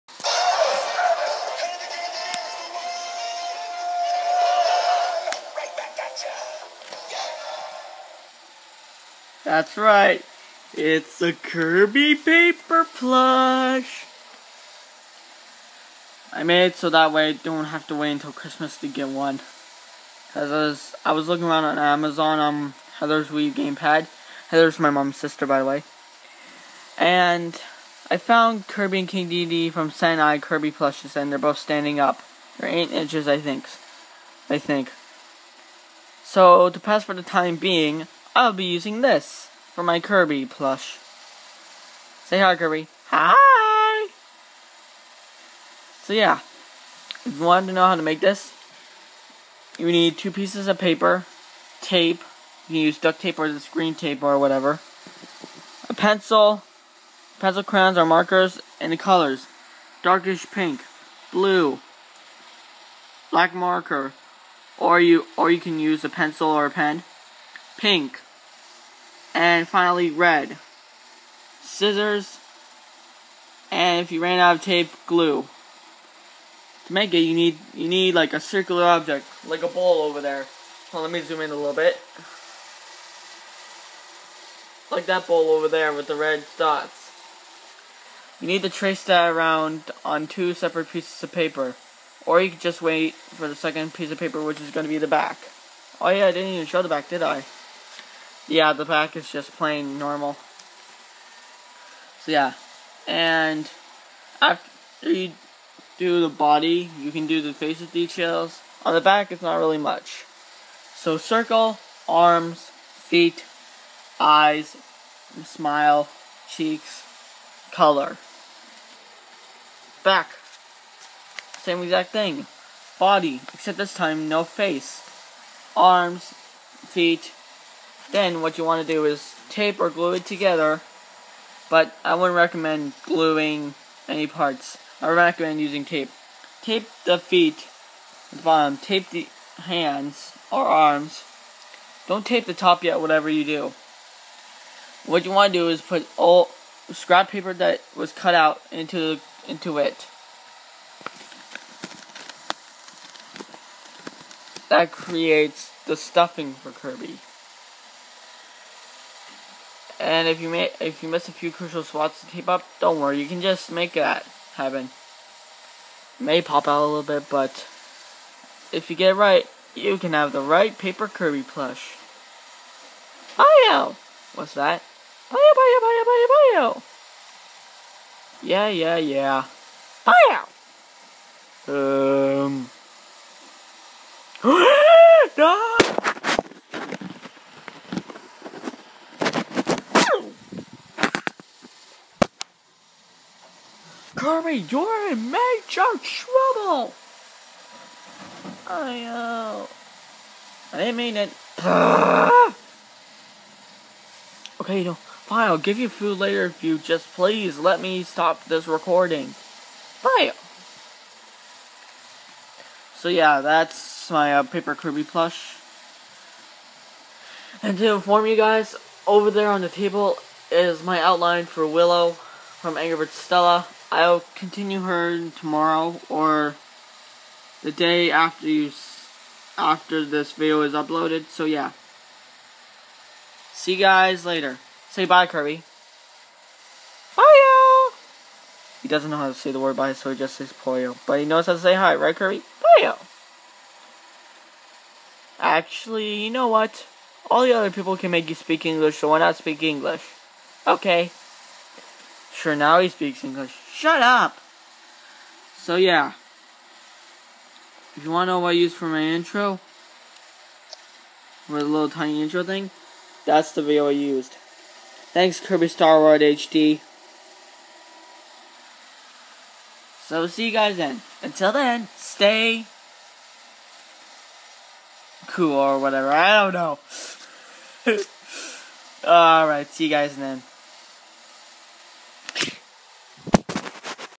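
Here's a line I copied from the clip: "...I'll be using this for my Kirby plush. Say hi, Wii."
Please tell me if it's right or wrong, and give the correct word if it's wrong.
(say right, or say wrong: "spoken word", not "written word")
wrong: "Kirby", not "Wii".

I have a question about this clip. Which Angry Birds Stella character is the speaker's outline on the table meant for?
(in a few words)
Willow.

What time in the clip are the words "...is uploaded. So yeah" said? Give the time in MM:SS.
03:50.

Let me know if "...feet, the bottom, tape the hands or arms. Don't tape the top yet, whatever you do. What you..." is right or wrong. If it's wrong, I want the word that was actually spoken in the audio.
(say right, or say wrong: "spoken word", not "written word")
right.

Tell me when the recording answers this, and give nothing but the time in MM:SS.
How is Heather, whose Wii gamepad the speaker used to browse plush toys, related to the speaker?
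00:24.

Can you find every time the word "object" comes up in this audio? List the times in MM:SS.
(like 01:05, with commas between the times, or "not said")
01:18.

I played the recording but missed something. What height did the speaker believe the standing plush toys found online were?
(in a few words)
8 inches.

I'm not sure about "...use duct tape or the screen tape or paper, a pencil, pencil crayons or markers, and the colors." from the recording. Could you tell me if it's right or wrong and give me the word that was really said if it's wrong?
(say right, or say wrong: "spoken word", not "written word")
wrong: "whatever", not "paper".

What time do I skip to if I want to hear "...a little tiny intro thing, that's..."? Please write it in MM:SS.
04:21.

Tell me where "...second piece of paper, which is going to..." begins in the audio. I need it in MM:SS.
01:33.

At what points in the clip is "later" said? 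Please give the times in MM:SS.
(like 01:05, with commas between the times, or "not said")
03:26, 03:54.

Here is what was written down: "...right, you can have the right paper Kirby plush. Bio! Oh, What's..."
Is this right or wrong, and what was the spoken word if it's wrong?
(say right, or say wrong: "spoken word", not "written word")
right.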